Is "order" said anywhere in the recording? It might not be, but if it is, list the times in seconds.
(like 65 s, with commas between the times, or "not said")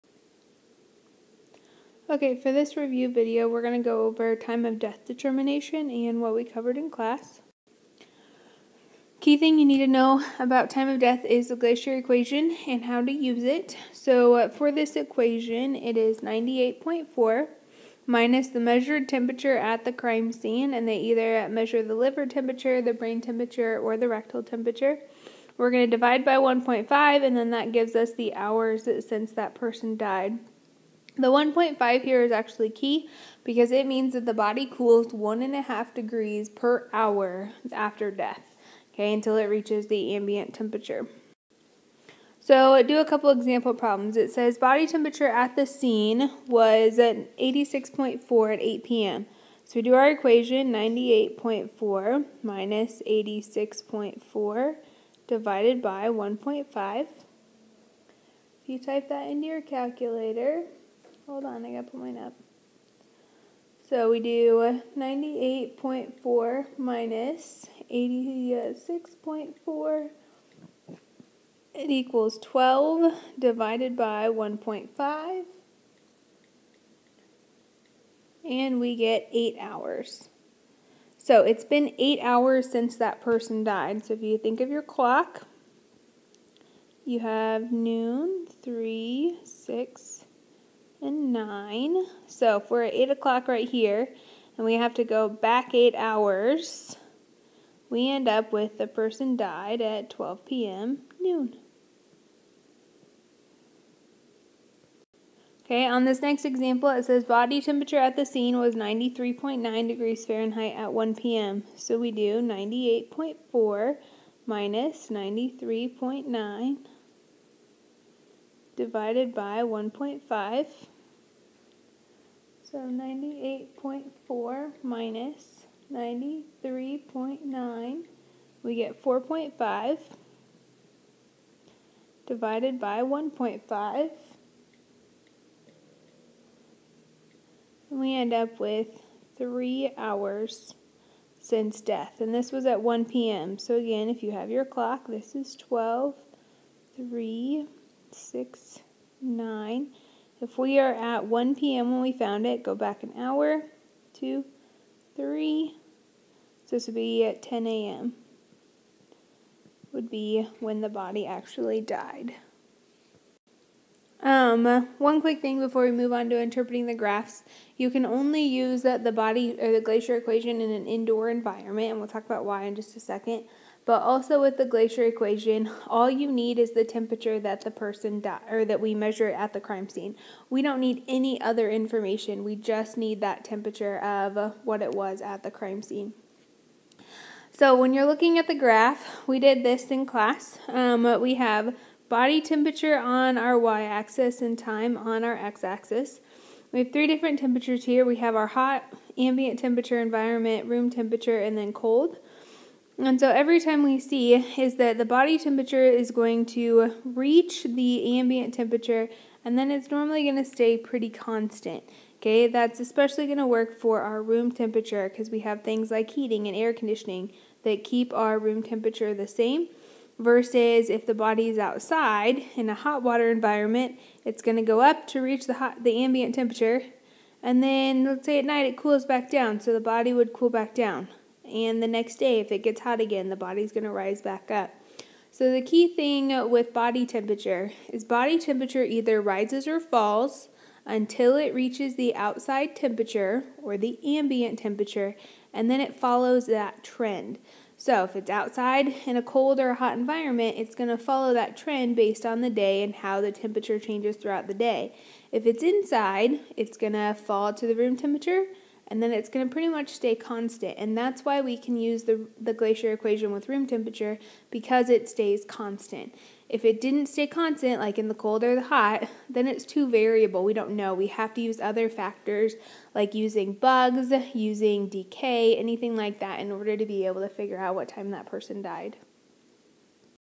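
276 s.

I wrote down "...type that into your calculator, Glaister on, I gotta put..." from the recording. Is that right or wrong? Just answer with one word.
wrong.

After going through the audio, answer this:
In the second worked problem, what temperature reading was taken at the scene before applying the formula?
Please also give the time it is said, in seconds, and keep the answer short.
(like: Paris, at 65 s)
93.9 degrees Fahrenheit, at 108 s.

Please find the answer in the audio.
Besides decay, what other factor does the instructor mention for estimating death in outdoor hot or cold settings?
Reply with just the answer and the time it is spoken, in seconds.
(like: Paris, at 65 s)
bugs, at 273 s.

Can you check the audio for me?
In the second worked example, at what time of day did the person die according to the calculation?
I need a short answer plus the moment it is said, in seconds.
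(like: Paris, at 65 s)
10 a.m., at 157 s.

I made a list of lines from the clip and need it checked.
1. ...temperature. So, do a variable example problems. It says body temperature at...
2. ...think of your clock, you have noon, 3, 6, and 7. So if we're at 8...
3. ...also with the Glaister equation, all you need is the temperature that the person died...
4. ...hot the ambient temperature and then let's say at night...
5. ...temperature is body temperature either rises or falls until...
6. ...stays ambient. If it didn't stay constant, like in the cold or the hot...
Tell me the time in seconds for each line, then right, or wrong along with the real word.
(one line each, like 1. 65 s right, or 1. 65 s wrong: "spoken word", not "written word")
1. 40 s wrong: "couple", not "variable"
2. 84 s wrong: "9", not "7"
3. 174 s right
4. 225 s right
5. 237 s right
6. 265 s wrong: "constant", not "ambient".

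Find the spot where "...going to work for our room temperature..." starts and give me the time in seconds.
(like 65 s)
213 s.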